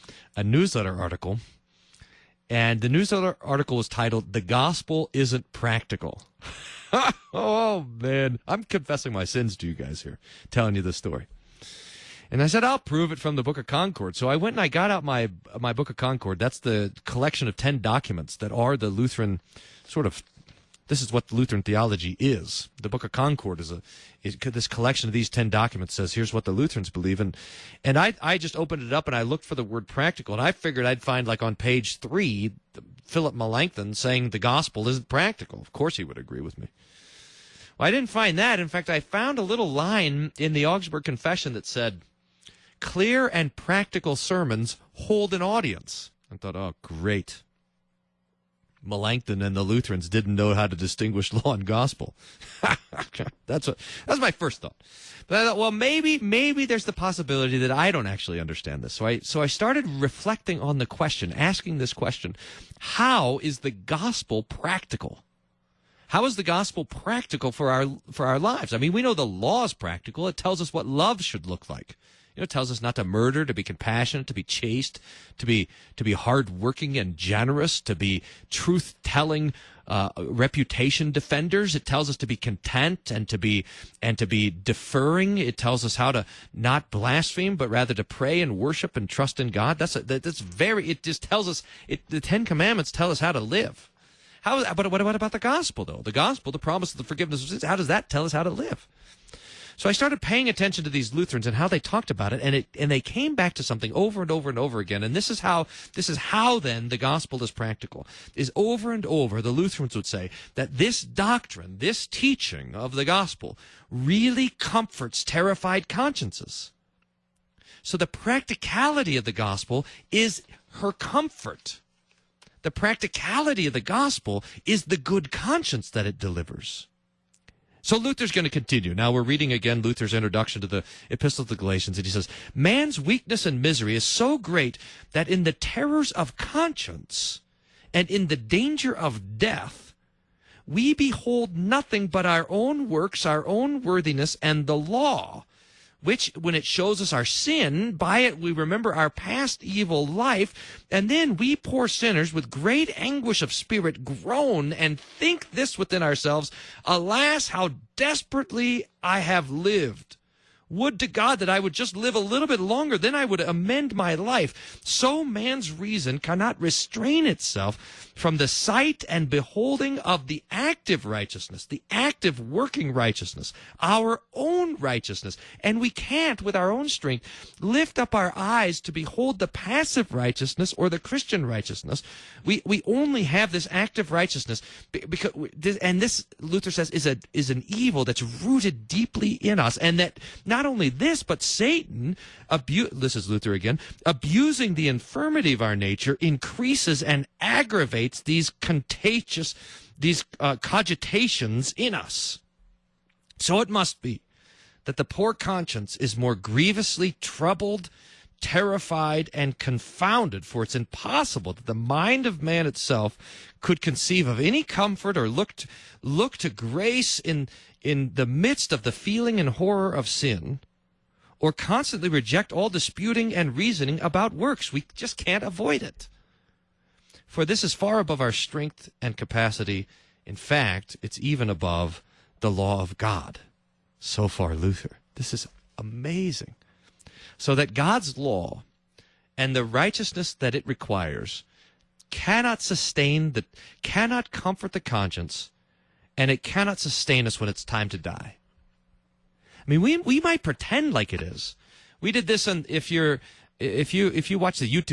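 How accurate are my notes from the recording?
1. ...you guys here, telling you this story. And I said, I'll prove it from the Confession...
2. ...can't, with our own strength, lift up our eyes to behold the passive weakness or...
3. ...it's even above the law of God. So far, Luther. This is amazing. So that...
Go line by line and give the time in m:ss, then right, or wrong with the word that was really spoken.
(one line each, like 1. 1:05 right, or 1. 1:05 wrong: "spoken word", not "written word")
1. 0:09 wrong: "Book", not "Confession"
2. 2:55 wrong: "righteousness", not "weakness"
3. 3:51 right.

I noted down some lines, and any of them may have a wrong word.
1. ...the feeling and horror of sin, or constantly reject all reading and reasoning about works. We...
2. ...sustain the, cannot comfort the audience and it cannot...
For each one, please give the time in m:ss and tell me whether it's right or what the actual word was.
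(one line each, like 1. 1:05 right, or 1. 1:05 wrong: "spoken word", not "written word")
1. 3:38 wrong: "disputing", not "reading"
2. 4:02 wrong: "conscience", not "audience".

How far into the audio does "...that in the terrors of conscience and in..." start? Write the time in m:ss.
2:15.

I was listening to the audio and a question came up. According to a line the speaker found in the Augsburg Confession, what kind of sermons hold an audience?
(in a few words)
Clear and practical.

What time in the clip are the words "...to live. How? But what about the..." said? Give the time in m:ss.
1:33.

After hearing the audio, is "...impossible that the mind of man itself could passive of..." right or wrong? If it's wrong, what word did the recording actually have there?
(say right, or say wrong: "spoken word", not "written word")
wrong: "conceive", not "passive".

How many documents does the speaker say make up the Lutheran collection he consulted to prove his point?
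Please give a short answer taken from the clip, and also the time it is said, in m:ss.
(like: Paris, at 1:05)
10, at 0:17.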